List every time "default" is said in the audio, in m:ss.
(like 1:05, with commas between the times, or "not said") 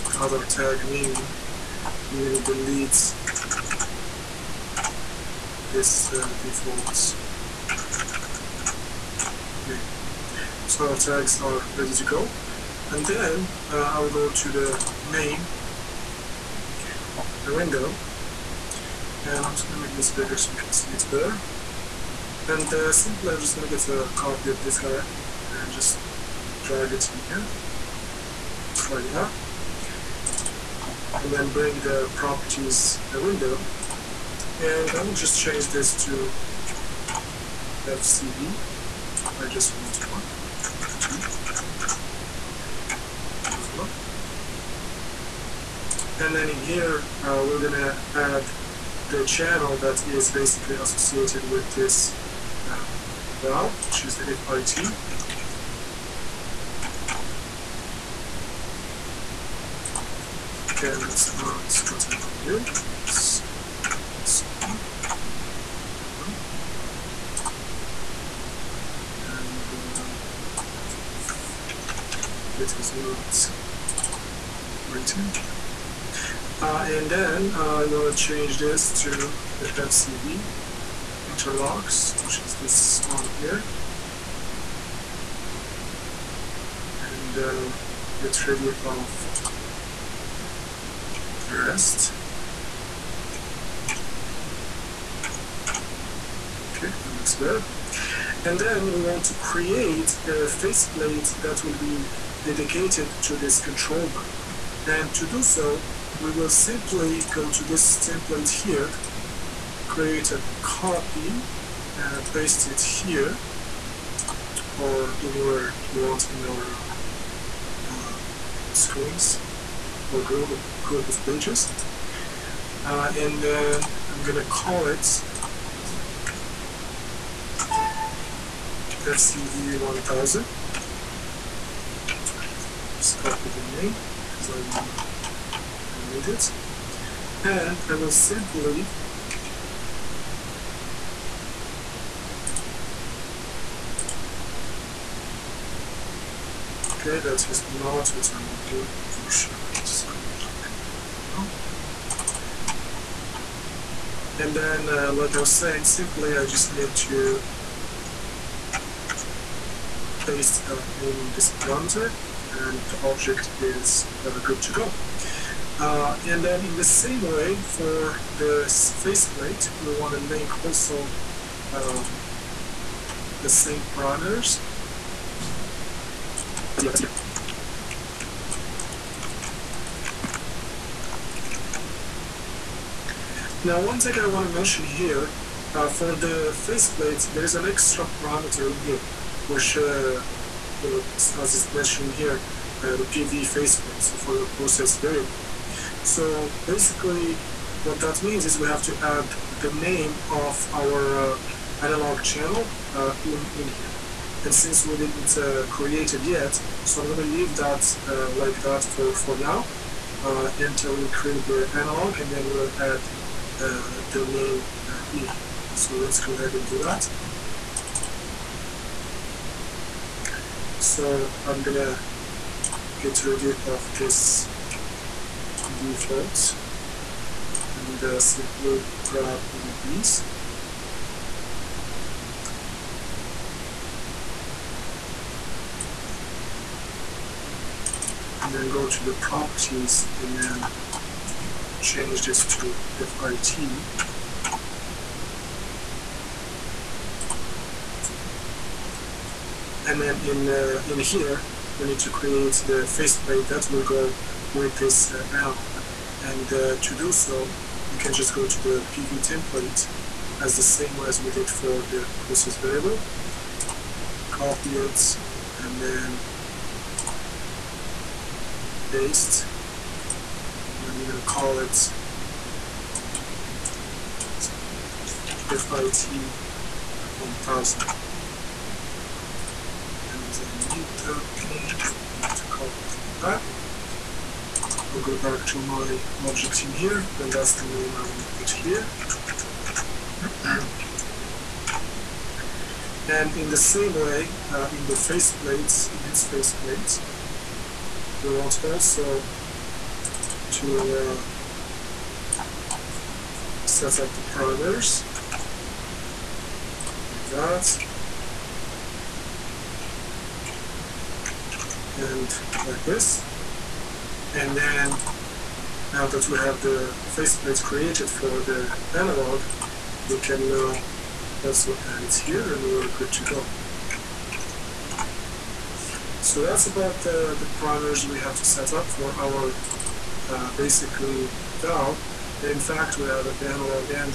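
0:06, 3:45.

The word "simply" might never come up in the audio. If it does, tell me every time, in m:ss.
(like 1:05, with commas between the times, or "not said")
0:22, 1:46, 2:18, 2:35, 3:48.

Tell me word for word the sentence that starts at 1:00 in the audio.
Okay, that's not what I want to do.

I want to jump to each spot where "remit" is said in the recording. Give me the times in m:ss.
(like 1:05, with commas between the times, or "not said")
not said.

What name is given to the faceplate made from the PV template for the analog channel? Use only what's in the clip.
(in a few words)
FIT 1000.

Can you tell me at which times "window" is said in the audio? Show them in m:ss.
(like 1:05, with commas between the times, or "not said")
0:17, 0:33.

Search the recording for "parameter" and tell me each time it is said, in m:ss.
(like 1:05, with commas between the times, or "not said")
2:41, 2:53, 3:08, 5:04.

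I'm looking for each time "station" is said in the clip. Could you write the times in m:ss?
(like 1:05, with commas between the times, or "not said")
not said.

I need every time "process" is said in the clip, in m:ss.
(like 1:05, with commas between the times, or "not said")
3:14, 4:22.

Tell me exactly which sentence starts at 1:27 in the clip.
And uh, get ready of the rest.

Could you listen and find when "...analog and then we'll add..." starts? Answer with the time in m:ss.
3:31.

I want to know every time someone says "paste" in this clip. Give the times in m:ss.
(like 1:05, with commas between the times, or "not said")
1:52, 2:40, 4:28.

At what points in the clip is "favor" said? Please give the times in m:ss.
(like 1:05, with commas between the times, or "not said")
not said.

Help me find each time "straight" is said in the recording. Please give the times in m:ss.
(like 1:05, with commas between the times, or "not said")
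not said.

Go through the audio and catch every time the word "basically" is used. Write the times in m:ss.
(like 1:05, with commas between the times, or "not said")
0:50, 3:16, 5:30.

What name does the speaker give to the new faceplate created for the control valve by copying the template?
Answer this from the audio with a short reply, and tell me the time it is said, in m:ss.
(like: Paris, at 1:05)
FCV 1000, at 2:08.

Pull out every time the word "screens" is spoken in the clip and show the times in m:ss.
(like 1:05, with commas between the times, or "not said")
1:58.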